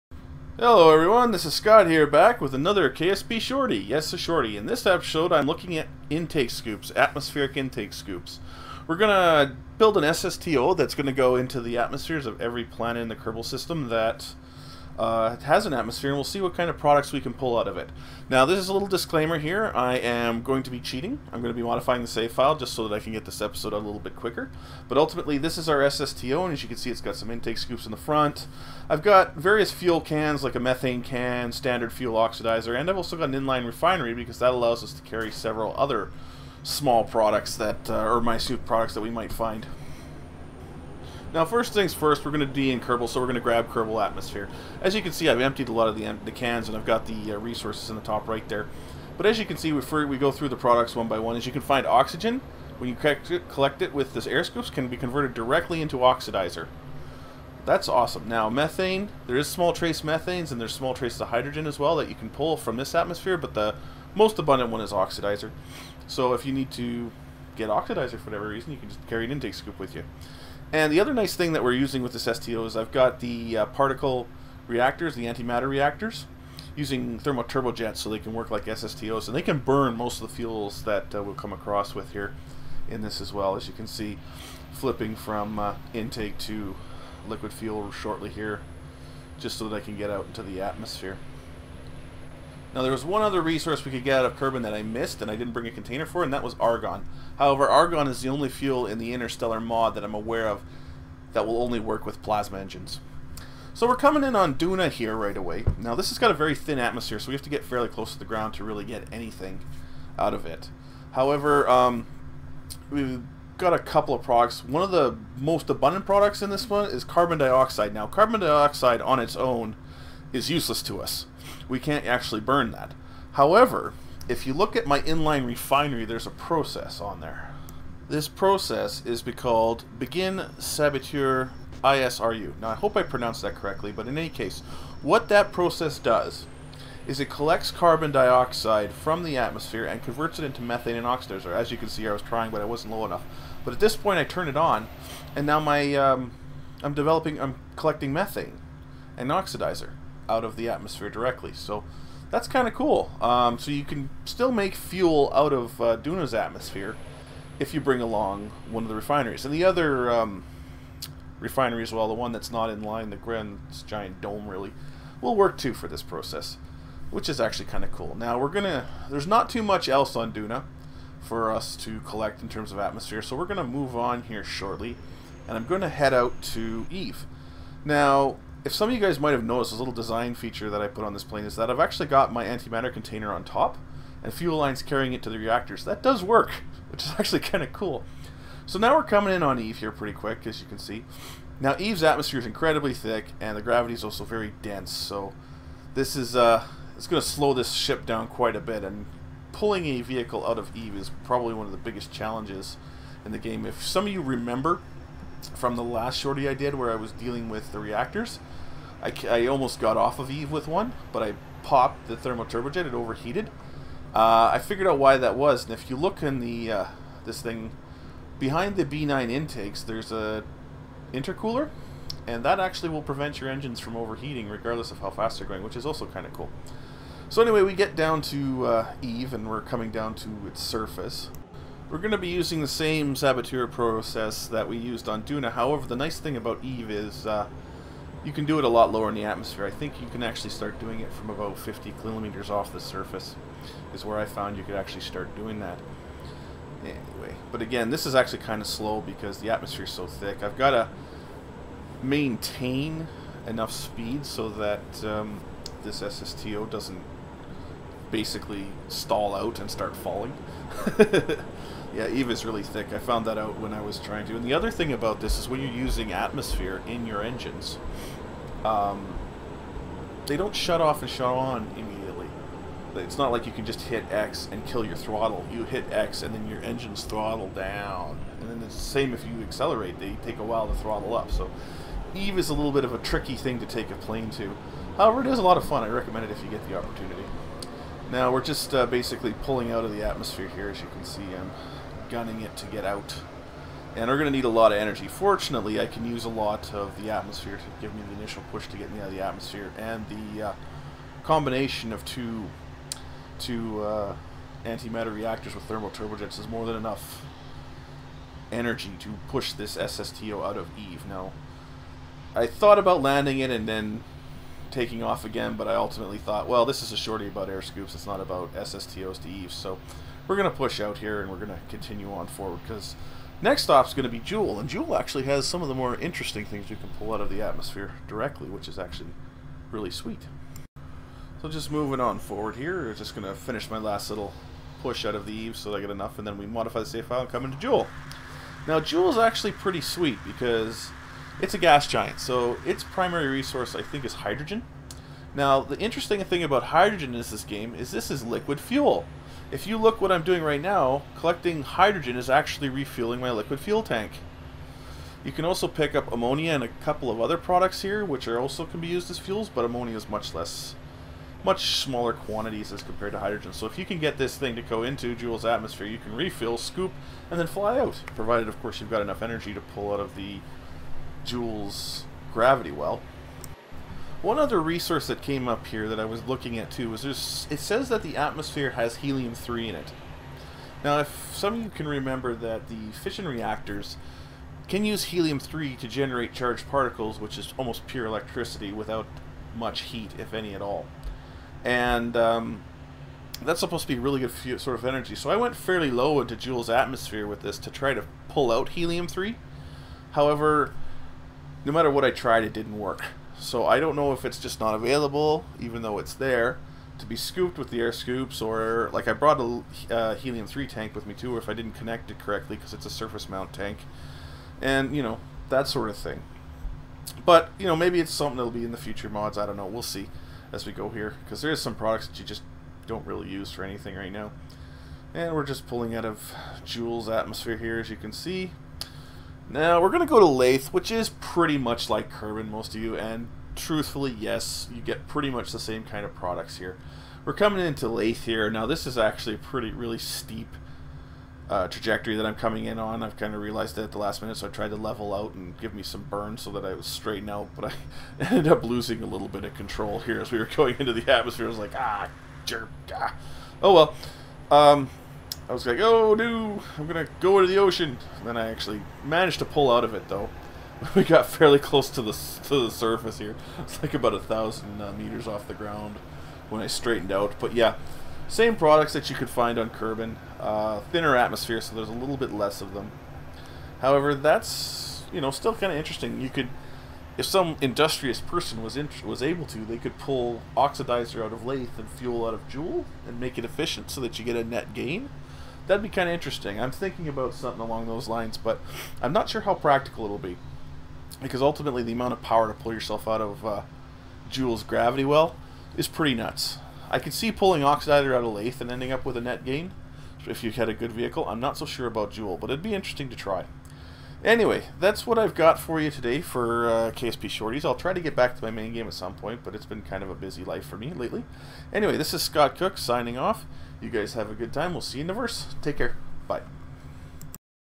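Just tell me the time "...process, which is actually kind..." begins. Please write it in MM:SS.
02:46.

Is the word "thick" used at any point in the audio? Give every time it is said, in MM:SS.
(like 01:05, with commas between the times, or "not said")
03:12, 04:10, 04:22.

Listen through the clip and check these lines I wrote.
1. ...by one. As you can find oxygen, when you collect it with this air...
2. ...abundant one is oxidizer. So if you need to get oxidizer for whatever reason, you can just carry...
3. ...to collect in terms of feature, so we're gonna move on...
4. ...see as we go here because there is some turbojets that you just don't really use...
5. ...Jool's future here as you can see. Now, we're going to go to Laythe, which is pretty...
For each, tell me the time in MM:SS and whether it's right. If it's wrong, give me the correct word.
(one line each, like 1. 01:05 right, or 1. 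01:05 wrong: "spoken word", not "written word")
1. 00:51 right
2. 01:04 right
3. 02:51 wrong: "atmosphere", not "feature"
4. 06:59 wrong: "products", not "turbojets"
5. 07:06 wrong: "atmosphere", not "future".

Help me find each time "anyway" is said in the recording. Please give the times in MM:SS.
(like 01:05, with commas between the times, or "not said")
03:47, 04:06, 08:24, 08:31.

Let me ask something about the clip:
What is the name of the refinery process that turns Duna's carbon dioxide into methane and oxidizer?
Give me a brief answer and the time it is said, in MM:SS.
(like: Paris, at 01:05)
Begin Sabatier ISRU, at 02:09.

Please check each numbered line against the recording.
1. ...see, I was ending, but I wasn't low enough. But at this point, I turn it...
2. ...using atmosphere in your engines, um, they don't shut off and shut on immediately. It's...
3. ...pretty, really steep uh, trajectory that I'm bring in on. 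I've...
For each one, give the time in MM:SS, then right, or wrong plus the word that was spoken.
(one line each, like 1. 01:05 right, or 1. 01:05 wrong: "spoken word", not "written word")
1. 02:21 wrong: "trying", not "ending"
2. 04:25 right
3. 07:19 wrong: "coming", not "bring".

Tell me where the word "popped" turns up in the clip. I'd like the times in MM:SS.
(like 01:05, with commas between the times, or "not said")
03:31.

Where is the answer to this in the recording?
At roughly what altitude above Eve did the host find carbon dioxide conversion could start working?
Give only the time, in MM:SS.
04:01.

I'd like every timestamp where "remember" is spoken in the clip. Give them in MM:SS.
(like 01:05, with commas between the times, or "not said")
03:24, 06:21.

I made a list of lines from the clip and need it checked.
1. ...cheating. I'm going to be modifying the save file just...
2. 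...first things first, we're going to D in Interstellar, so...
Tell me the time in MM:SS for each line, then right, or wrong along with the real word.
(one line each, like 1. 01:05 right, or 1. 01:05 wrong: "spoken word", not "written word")
1. 00:20 right
2. 00:41 wrong: "Kerbal", not "Interstellar".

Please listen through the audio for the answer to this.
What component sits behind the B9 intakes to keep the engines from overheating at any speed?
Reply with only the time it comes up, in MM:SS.
03:41.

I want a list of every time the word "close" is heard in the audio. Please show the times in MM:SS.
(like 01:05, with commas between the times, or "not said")
01:47, 07:41.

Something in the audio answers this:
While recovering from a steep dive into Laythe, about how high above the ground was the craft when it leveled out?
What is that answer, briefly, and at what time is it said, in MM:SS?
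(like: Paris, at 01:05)
1000 meters, at 07:44.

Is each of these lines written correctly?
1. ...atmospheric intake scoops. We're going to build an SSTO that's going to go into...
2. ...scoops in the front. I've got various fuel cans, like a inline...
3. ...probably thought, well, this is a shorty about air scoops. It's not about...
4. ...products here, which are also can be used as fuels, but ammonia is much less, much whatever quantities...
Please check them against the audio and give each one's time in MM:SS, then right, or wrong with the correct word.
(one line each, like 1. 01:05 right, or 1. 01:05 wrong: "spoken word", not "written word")
1. 00:06 right
2. 00:27 wrong: "methane", not "inline"
3. 05:15 wrong: "ultimately", not "probably"
4. 05:57 wrong: "smaller", not "whatever".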